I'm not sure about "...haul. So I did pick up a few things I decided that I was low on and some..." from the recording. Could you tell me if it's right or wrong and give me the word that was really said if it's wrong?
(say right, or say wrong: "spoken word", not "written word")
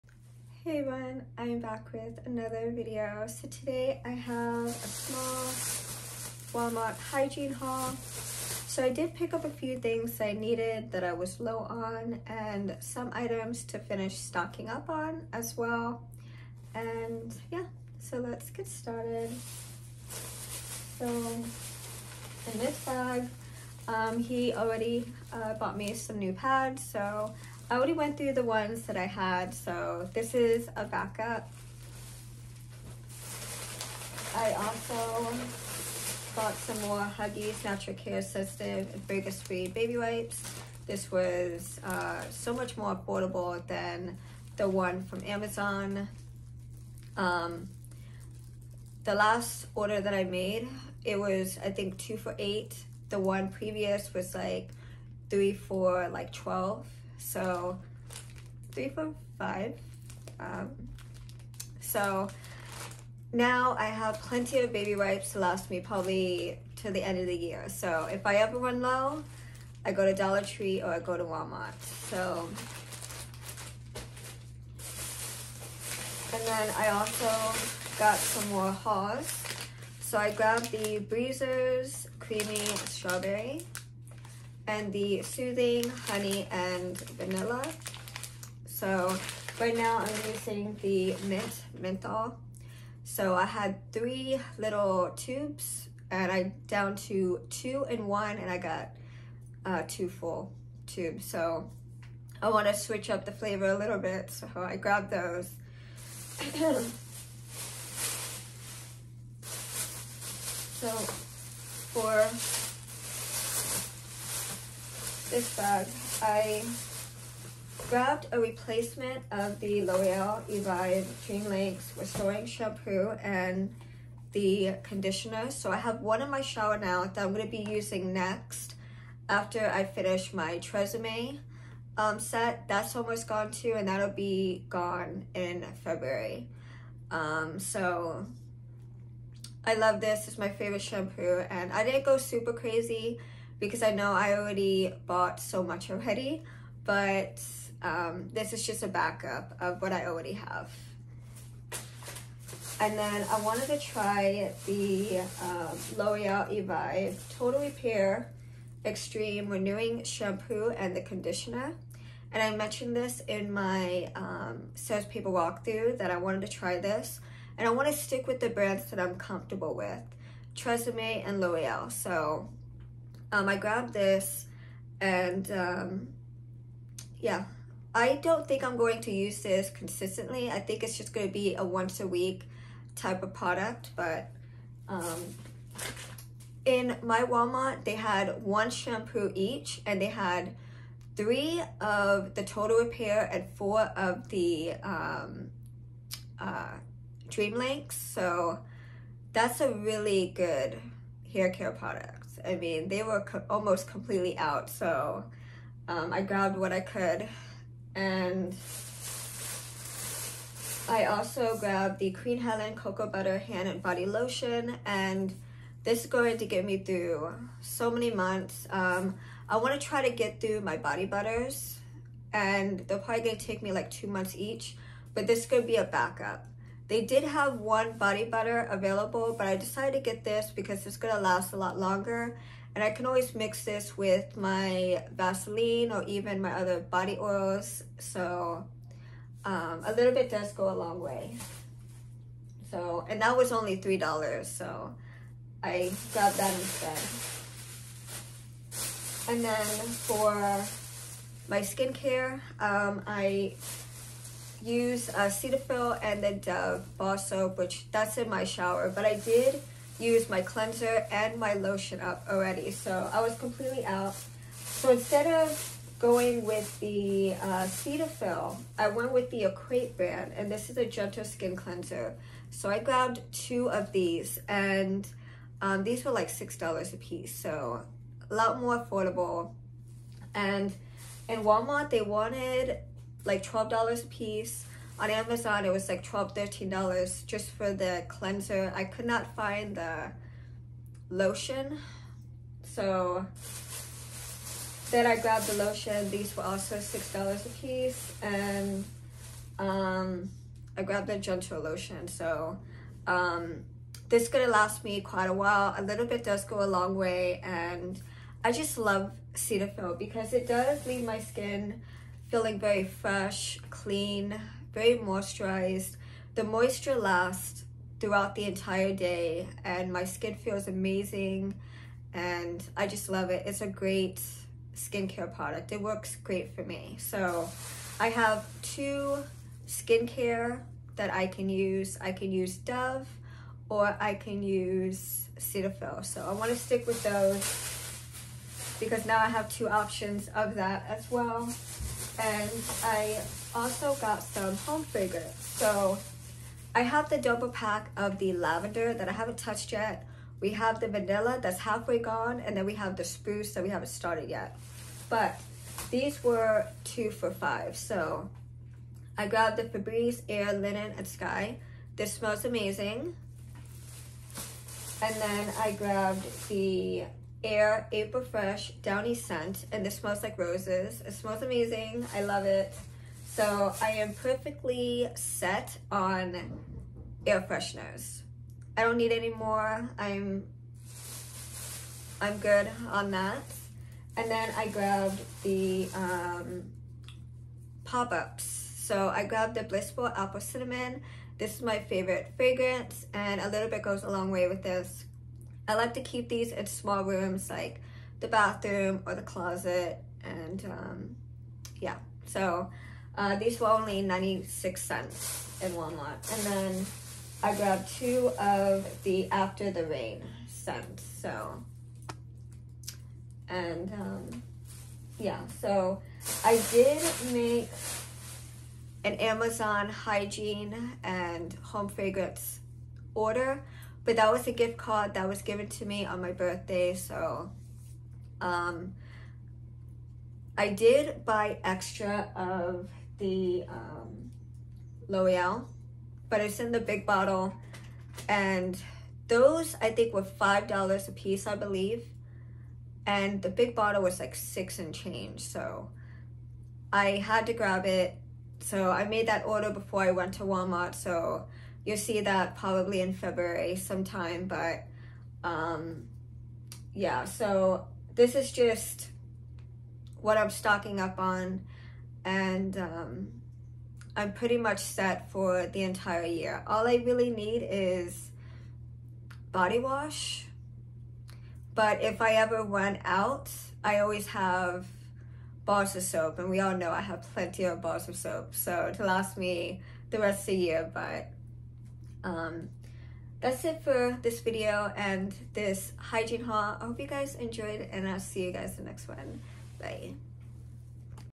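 wrong: "needed", not "decided".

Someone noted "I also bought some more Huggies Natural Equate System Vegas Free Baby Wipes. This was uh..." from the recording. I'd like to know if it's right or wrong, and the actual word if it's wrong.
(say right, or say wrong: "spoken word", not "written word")
wrong: "Care", not "Equate".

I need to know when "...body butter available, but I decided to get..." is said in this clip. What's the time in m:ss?
3:47.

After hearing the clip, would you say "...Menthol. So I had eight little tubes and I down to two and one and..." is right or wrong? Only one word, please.
wrong.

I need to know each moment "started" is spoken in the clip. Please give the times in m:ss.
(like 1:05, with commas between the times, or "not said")
0:18, 5:53.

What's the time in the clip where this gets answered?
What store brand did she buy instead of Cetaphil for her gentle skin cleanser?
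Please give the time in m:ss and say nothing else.
4:29.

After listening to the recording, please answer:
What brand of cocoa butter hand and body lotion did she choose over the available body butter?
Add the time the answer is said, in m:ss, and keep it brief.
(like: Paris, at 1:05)
Queen Helene, at 3:32.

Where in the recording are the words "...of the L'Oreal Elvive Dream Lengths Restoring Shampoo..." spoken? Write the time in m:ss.
1:59.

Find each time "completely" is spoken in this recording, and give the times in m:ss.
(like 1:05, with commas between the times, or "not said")
3:23, 4:23.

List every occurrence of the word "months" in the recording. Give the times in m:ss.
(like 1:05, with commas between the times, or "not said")
3:38, 3:44.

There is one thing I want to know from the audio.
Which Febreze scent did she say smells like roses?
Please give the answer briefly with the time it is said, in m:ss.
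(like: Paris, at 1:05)
April Fresh Downy, at 6:07.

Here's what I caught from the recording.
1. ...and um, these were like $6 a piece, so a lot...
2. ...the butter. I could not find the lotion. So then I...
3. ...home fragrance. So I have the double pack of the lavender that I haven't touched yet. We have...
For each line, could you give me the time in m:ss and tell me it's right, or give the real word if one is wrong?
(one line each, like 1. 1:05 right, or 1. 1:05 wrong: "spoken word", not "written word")
1. 4:34 right
2. 4:47 wrong: "cleanser", not "butter"
3. 5:44 right.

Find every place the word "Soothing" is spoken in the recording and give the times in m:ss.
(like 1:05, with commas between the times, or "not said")
1:25.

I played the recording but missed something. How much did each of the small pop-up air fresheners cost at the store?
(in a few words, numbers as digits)
96 cents.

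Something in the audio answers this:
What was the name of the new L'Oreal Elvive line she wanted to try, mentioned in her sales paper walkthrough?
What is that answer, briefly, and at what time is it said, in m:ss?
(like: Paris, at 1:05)
Total Repair Extreme, at 2:37.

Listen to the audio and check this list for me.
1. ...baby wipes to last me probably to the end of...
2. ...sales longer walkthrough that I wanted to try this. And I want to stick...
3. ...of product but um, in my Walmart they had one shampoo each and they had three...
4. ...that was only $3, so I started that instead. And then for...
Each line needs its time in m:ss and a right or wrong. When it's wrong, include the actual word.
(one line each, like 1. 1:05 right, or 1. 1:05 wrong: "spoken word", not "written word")
1. 1:04 right
2. 2:44 wrong: "paper", not "longer"
3. 3:03 right
4. 4:03 wrong: "grabbed", not "started".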